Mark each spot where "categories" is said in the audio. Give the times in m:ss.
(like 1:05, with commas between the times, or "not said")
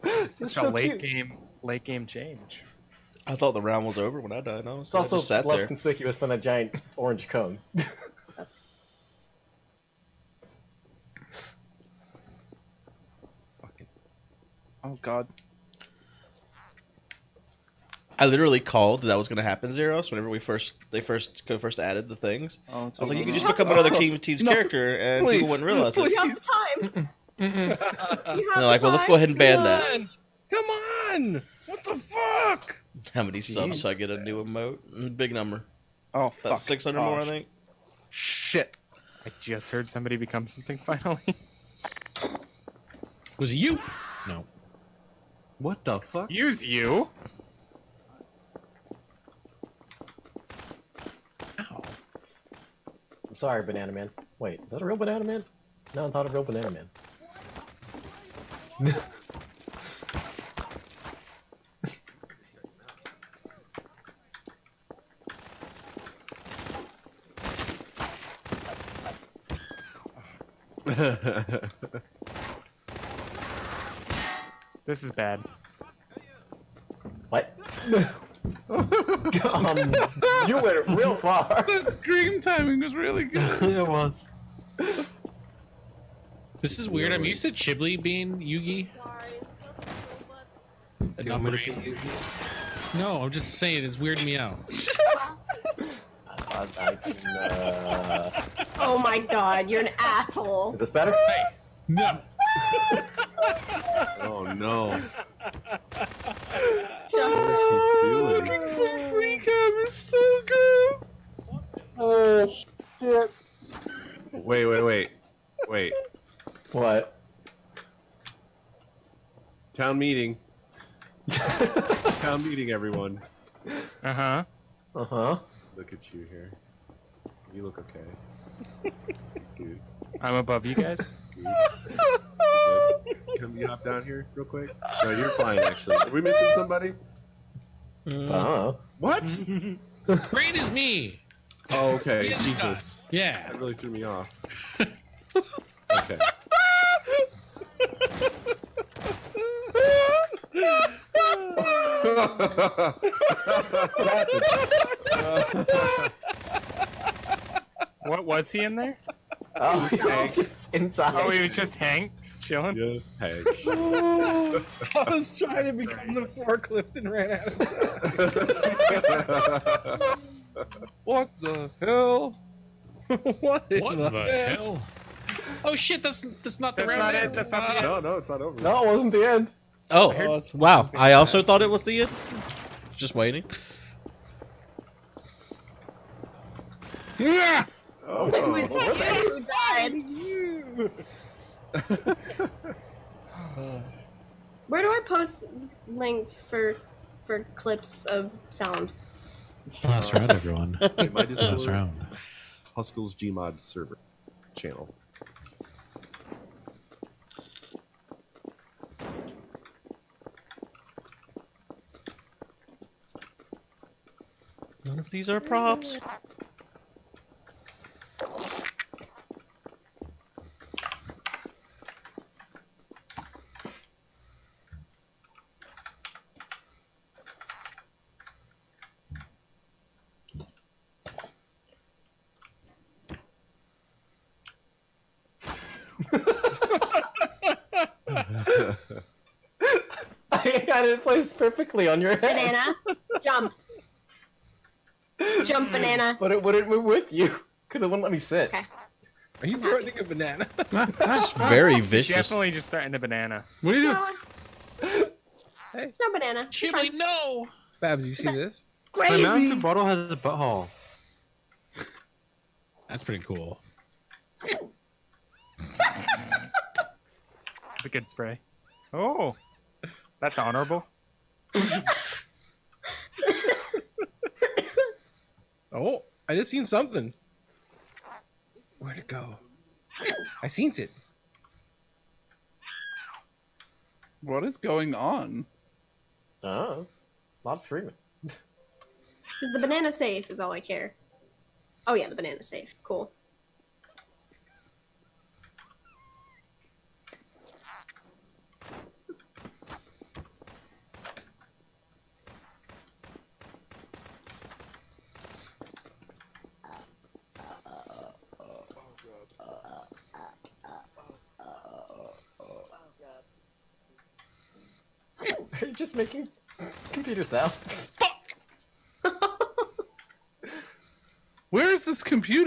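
not said.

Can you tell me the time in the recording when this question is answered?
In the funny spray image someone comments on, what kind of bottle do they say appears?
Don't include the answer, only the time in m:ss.
4:19.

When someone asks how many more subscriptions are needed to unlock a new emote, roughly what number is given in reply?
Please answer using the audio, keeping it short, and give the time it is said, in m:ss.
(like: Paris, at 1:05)
600, at 0:36.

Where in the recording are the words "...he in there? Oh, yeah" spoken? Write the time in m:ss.
2:38.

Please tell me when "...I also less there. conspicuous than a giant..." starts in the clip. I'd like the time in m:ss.
0:04.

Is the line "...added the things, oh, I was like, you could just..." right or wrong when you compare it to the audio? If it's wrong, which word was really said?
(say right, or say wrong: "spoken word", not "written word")
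right.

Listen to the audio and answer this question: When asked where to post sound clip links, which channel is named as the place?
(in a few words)
Huskell's Gmod server channel.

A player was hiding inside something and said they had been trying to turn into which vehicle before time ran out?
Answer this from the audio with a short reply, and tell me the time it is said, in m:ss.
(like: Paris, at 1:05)
forklift, at 2:46.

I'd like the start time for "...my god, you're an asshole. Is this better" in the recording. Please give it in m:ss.
1:38.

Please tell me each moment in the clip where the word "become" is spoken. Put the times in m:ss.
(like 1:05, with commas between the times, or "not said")
0:23, 0:40, 2:45.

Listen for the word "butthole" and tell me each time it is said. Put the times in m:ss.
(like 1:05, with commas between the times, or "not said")
4:20.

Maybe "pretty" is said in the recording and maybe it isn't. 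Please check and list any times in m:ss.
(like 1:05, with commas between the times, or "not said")
4:23.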